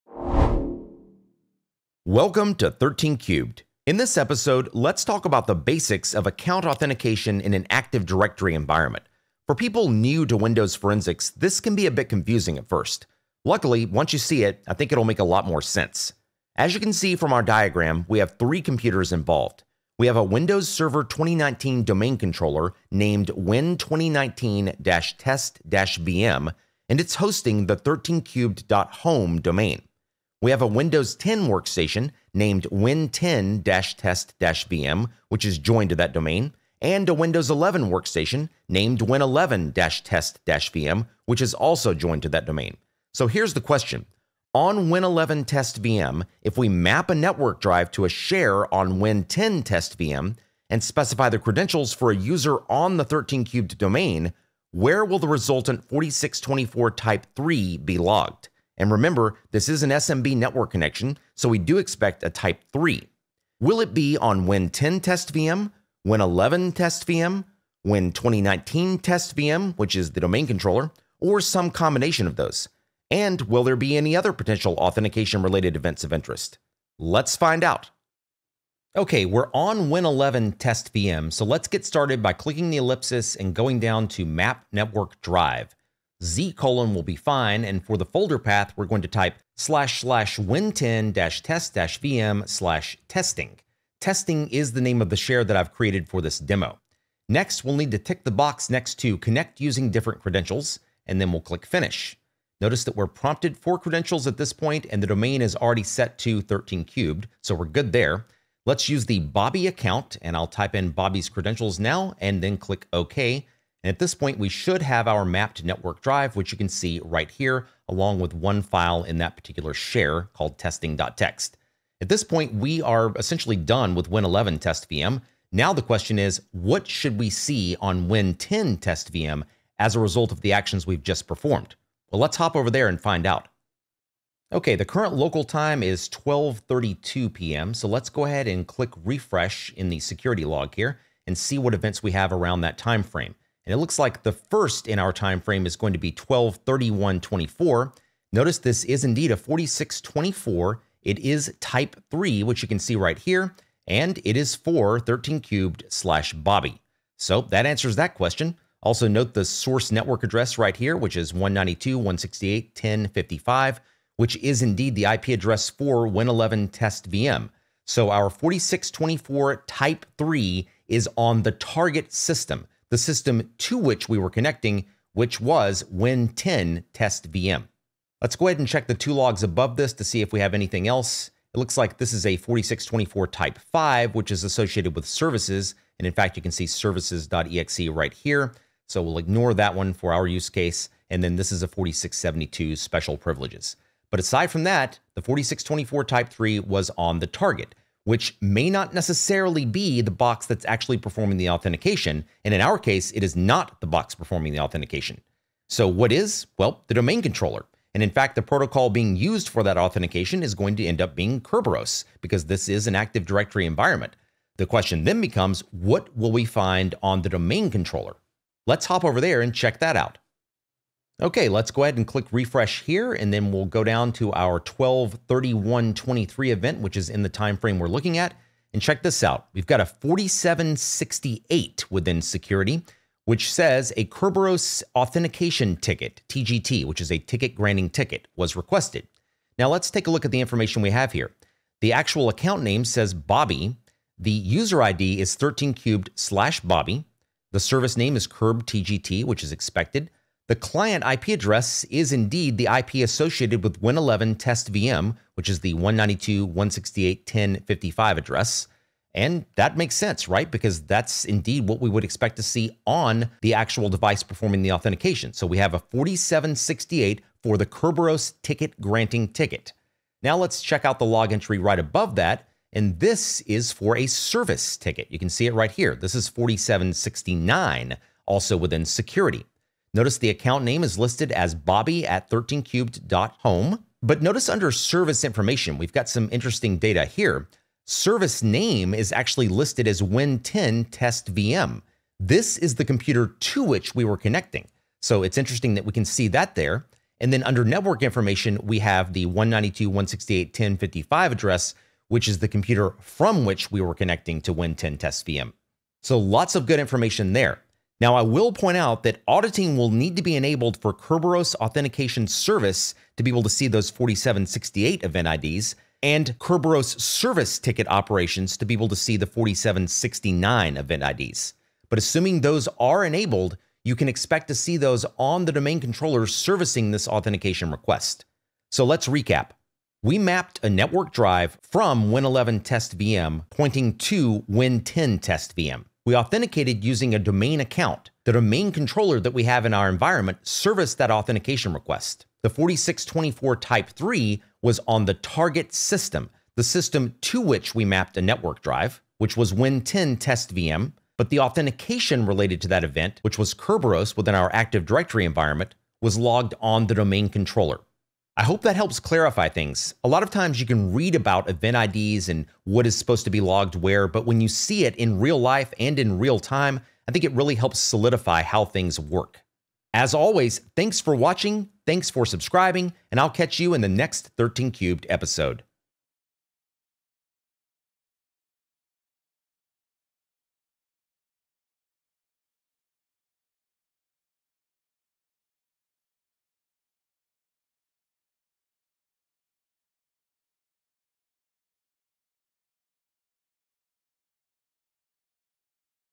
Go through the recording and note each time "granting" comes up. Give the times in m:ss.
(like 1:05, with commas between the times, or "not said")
3:57, 4:28.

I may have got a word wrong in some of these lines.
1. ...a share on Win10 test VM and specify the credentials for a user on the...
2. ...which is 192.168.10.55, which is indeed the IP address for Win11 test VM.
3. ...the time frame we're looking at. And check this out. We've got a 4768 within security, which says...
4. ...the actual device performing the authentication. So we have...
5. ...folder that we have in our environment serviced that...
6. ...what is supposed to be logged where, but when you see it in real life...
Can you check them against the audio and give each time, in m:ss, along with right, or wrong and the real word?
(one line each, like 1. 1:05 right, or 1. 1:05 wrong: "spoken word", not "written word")
1. 0:48 right
2. 2:40 right
3. 3:47 right
4. 4:23 right
5. 5:38 wrong: "controller", not "folder"
6. 6:02 right.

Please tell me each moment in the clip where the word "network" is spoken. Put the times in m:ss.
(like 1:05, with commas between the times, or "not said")
0:47, 1:00, 1:24, 1:55, 2:39, 4:57, 5:30, 5:48.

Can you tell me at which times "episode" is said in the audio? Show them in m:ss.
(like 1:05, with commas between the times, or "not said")
0:04, 6:15.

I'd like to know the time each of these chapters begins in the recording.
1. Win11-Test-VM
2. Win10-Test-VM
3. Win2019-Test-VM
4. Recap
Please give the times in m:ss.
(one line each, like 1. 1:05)
1. 1:18
2. 2:14
3. 3:41
4. 5:28.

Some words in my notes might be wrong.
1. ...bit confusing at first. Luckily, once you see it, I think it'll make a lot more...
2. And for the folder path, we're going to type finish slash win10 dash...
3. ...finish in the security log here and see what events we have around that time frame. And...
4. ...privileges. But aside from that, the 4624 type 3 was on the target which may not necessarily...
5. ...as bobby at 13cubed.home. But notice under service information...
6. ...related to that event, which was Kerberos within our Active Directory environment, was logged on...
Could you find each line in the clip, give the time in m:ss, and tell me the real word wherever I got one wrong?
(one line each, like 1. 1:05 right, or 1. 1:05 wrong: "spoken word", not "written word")
1. 0:11 right
2. 1:27 wrong: "slash", not "finish"
3. 2:19 wrong: "refresh", not "finish"
4. 3:13 right
5. 4:41 right
6. 5:52 right.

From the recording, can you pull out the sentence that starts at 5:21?
But assuming those are enabled, you can expect to see those on the domain controller servicing this authentication request.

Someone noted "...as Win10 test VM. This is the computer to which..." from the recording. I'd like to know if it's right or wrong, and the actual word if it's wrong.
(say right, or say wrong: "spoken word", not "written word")
right.